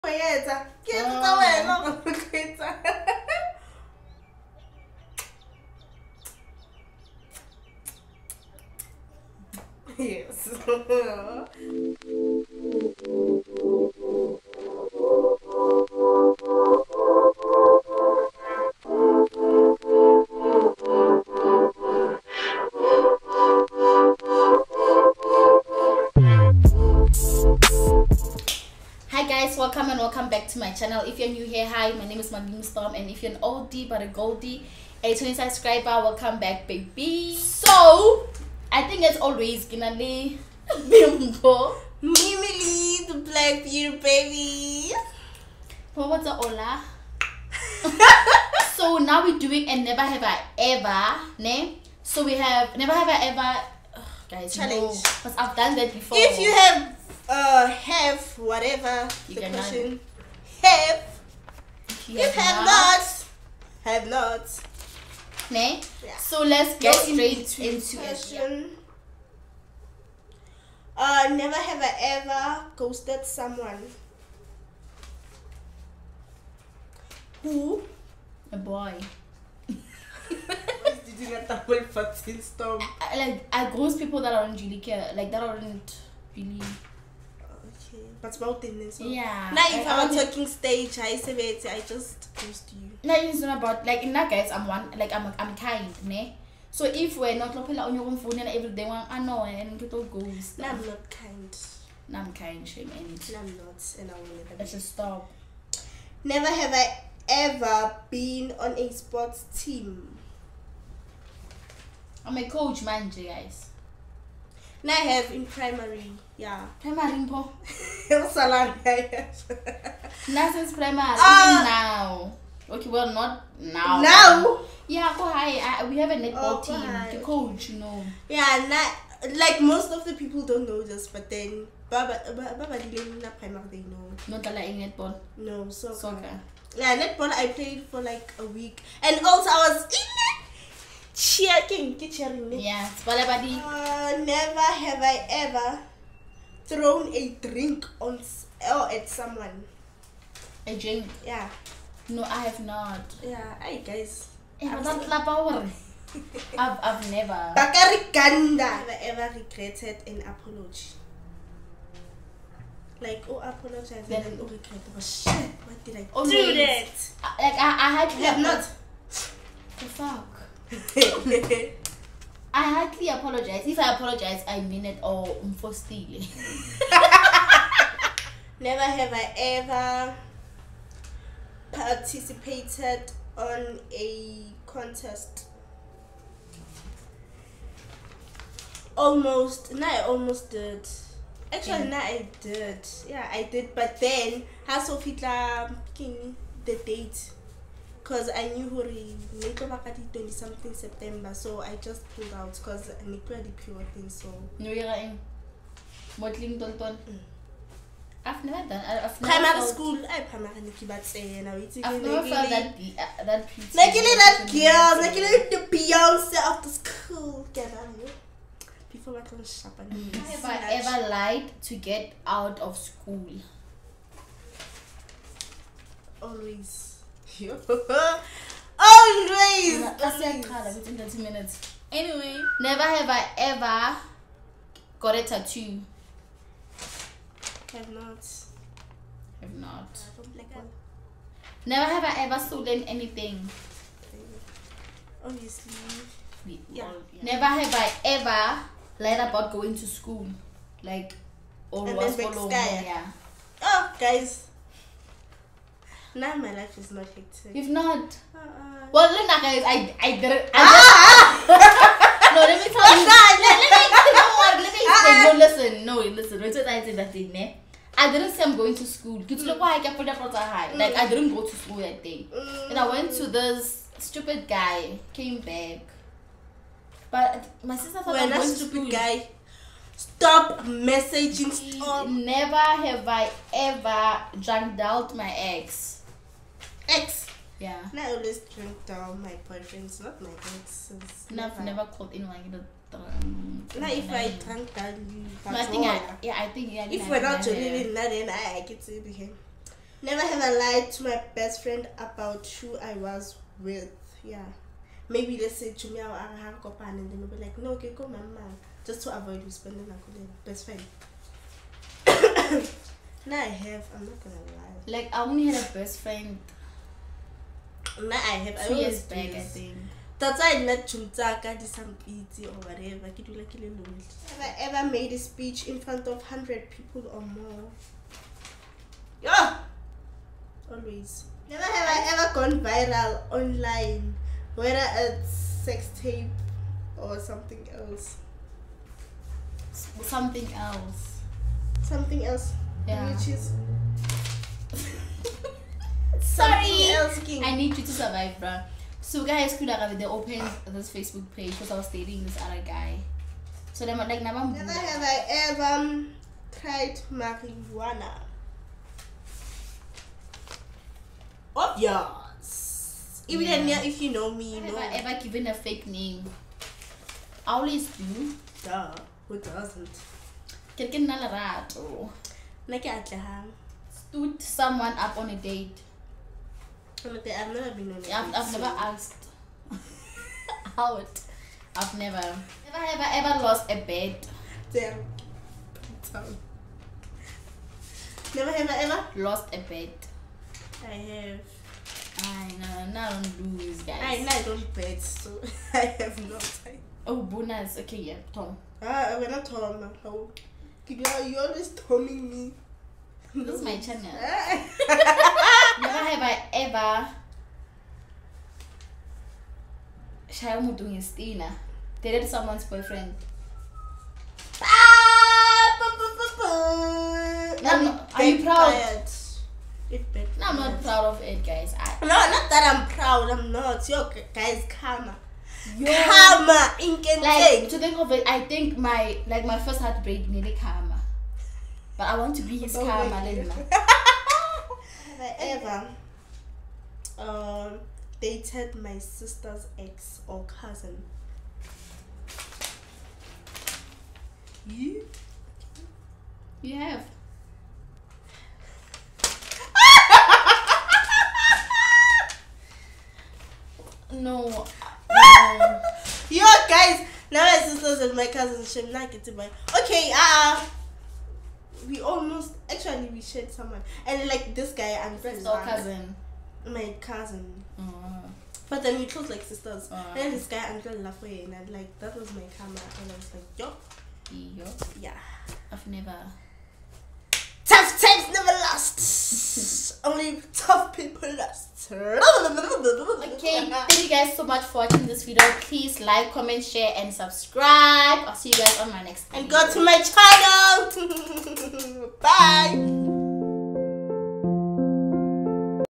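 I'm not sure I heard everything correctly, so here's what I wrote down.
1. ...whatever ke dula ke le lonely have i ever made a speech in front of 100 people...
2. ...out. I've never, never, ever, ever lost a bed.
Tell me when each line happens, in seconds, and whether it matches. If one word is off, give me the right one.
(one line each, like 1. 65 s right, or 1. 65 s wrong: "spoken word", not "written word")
1. 322 s right
2. 380 s right.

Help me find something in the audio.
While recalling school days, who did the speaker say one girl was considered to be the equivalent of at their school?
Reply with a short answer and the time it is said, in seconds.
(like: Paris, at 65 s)
Beyonce, at 215 s.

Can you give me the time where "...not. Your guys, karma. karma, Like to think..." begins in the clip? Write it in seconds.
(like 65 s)
423 s.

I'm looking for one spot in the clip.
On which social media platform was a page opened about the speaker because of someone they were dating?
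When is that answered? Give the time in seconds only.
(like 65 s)
350 s.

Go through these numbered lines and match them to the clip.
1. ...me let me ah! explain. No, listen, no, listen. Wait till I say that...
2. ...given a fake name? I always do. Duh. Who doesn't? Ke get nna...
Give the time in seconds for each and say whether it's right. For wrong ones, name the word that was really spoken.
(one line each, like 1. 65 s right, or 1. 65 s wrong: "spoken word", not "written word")
1. 263 s right
2. 365 s right.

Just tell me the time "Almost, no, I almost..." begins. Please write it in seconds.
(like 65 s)
188 s.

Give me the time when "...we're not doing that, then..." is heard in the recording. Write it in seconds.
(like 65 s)
297 s.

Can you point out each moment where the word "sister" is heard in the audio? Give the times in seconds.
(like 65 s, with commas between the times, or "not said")
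277 s, 438 s, 457 s, 469 s.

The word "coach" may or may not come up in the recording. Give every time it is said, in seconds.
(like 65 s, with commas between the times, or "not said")
112 s, 127 s.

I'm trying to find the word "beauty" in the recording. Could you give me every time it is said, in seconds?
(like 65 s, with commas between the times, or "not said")
43 s, 213 s.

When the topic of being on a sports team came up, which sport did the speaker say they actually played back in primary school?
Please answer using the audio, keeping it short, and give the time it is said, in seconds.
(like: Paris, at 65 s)
Soccer, at 135 s.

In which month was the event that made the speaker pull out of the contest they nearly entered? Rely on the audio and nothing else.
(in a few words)
September.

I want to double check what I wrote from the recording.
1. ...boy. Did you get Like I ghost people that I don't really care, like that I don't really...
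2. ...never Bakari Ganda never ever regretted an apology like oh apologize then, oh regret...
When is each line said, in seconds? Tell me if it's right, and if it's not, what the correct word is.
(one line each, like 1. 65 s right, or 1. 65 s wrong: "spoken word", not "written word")
1. 78 s right
2. 157 s right.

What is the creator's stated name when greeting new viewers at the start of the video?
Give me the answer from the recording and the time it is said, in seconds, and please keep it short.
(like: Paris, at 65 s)
Maledimo Storm, at 32 s.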